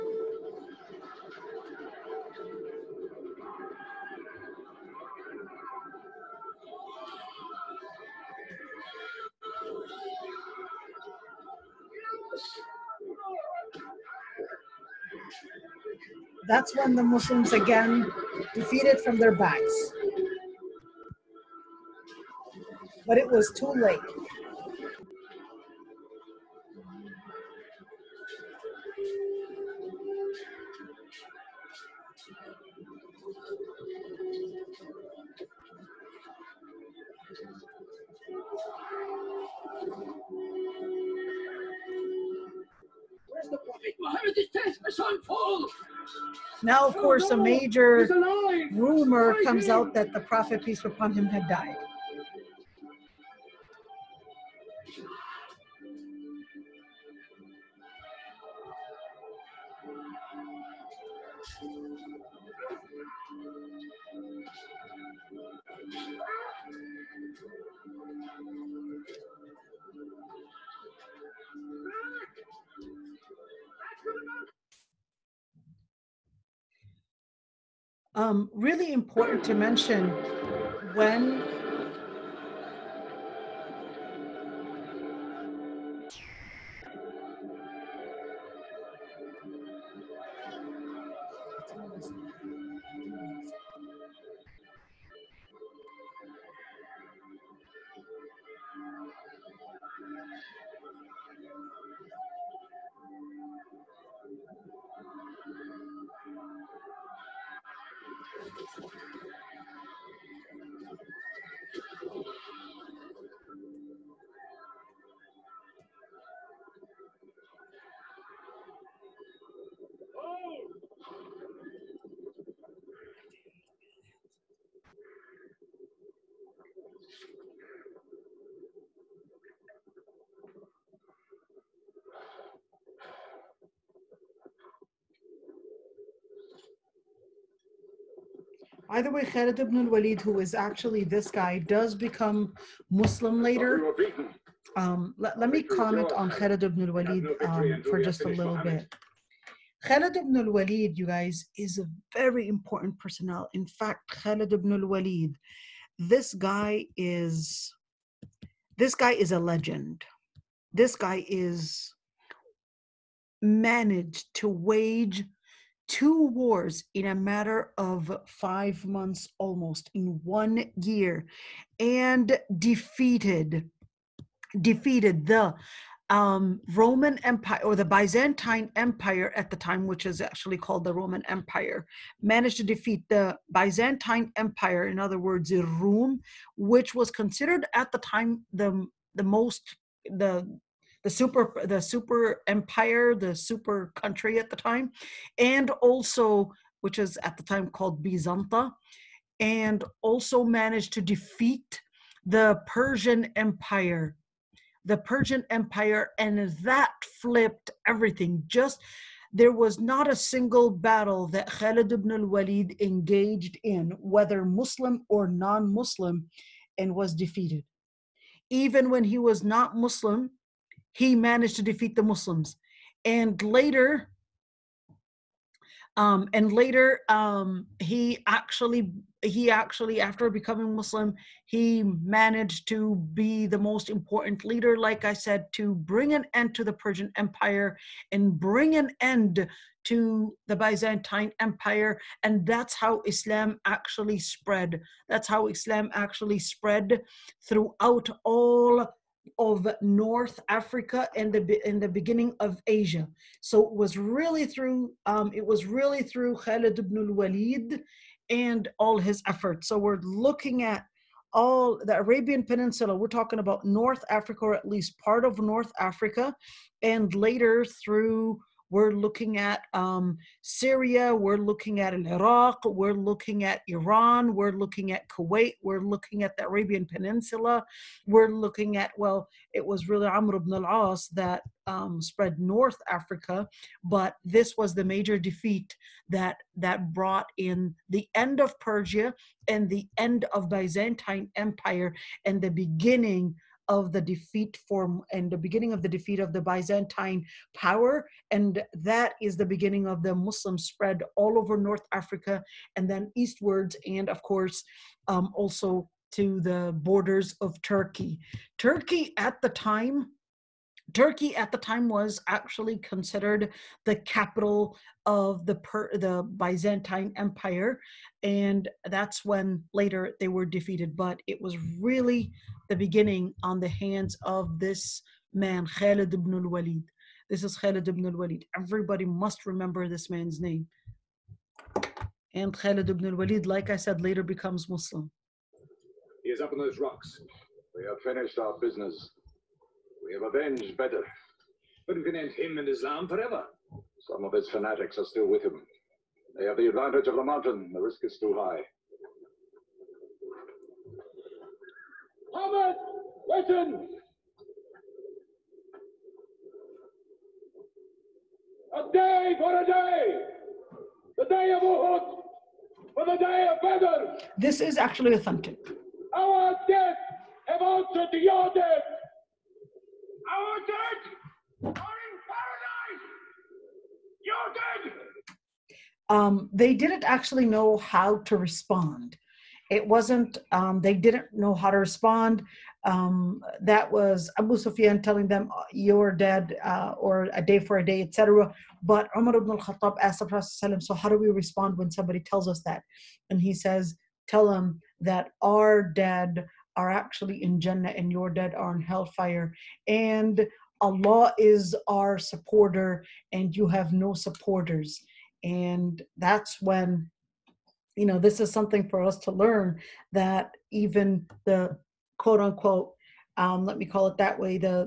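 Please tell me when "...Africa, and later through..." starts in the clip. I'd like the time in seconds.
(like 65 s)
265 s.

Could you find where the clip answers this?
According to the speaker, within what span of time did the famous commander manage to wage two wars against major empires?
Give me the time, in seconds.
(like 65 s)
168 s.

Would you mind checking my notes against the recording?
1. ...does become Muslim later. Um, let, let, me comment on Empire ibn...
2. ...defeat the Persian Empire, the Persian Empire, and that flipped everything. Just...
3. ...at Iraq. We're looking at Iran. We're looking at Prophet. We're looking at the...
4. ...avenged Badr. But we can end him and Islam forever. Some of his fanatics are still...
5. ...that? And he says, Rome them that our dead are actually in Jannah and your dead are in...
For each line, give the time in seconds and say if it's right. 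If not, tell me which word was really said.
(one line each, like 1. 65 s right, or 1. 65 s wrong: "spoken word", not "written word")
1. 141 s wrong: "Khalid", not "Empire"
2. 201 s right
3. 271 s wrong: "Kuwait", not "Prophet"
4. 340 s right
5. 392 s wrong: "Tell", not "Rome".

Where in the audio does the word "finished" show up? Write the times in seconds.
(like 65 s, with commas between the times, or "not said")
338 s.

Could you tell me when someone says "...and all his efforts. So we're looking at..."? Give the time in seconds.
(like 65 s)
258 s.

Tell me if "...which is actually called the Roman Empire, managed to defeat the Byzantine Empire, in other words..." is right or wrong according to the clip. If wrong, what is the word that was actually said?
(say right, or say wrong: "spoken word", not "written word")
right.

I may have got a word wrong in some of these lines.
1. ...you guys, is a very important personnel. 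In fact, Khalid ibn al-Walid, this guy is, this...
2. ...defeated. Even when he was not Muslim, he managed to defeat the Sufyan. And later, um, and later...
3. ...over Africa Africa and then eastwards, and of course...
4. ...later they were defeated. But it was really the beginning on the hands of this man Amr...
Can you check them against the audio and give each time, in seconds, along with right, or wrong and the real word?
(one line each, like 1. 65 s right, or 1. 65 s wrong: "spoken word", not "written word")
1. 150 s right
2. 217 s wrong: "Muslims", not "Sufyan"
3. 301 s wrong: "North", not "Africa"
4. 319 s wrong: "Khalid", not "Amr".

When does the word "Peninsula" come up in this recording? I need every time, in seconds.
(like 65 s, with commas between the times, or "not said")
262 s, 276 s.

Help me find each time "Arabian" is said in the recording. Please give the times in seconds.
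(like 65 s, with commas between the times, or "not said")
261 s, 276 s.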